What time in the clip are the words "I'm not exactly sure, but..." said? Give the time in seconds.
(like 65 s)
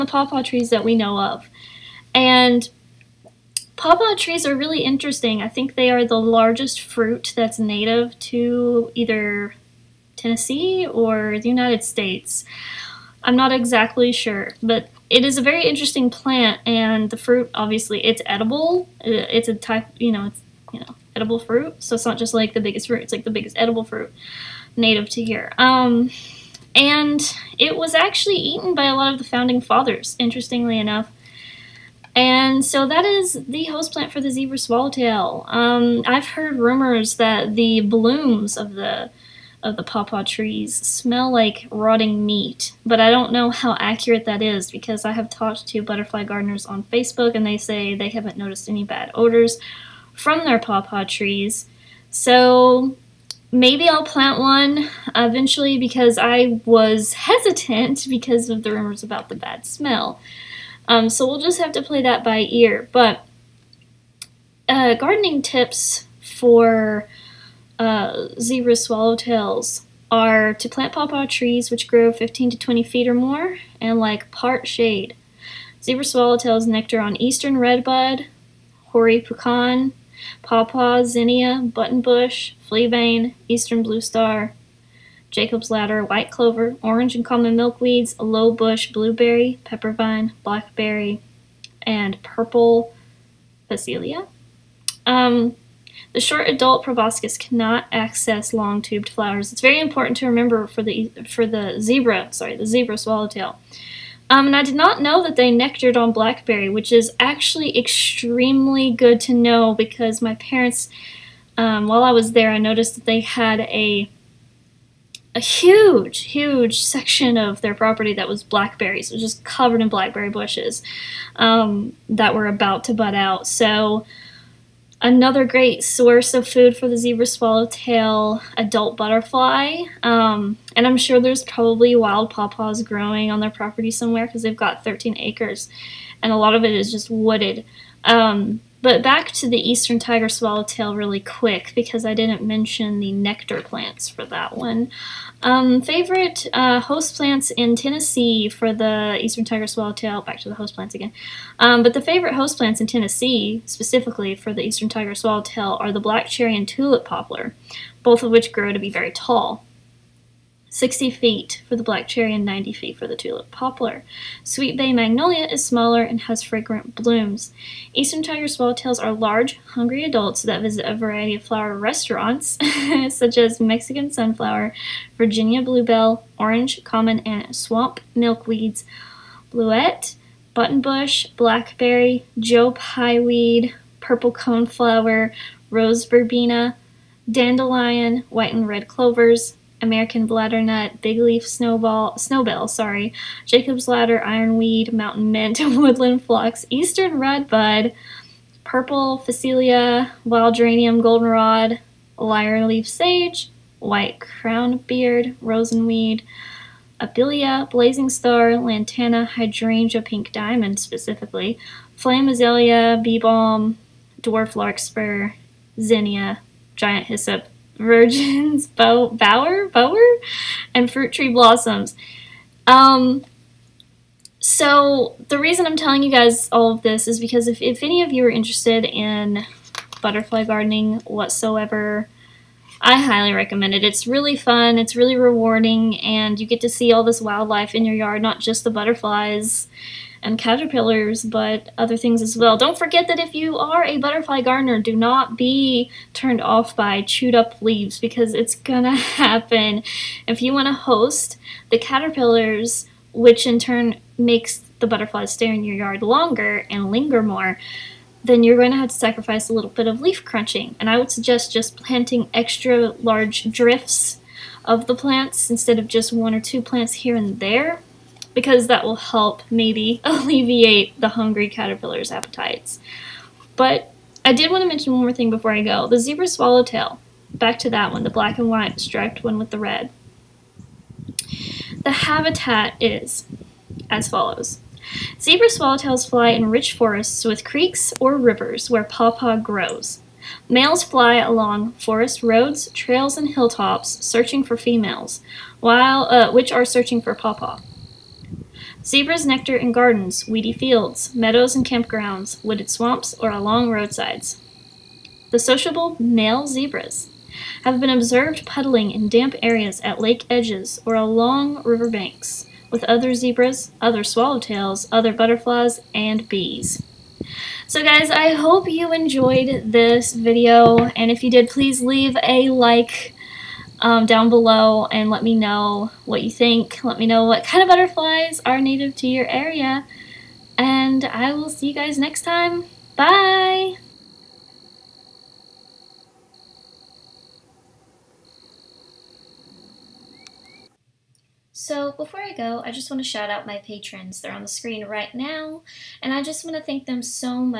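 13 s.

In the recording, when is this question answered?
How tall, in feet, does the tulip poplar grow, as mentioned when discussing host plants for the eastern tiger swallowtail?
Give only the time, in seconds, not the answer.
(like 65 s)
162 s.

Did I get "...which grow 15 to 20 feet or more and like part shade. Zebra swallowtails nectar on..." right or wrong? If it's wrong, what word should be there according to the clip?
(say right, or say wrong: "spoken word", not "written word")
right.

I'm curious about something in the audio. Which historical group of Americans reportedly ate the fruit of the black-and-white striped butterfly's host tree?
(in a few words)
Founding fathers.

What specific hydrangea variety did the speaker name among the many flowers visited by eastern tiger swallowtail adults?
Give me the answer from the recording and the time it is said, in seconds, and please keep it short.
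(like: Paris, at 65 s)
Pink Diamond, at 210 s.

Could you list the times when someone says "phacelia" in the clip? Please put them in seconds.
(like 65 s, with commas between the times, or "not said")
93 s, 199 s.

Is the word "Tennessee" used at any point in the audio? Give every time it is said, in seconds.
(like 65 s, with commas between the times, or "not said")
10 s, 147 s, 152 s.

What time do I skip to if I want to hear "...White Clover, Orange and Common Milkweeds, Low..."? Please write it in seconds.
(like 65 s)
86 s.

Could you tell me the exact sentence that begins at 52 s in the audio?
So maybe I'll plant one eventually because I was hesitant because of the rumors about the bad smell.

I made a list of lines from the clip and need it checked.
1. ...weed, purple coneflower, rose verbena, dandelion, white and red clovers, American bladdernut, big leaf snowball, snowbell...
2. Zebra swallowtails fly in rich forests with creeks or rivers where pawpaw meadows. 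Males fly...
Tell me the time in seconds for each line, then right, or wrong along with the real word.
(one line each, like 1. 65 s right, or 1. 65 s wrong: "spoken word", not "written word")
1. 183 s right
2. 285 s wrong: "grows", not "meadows".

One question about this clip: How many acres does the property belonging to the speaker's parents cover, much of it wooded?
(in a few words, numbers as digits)
13.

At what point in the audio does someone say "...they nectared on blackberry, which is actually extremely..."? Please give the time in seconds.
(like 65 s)
105 s.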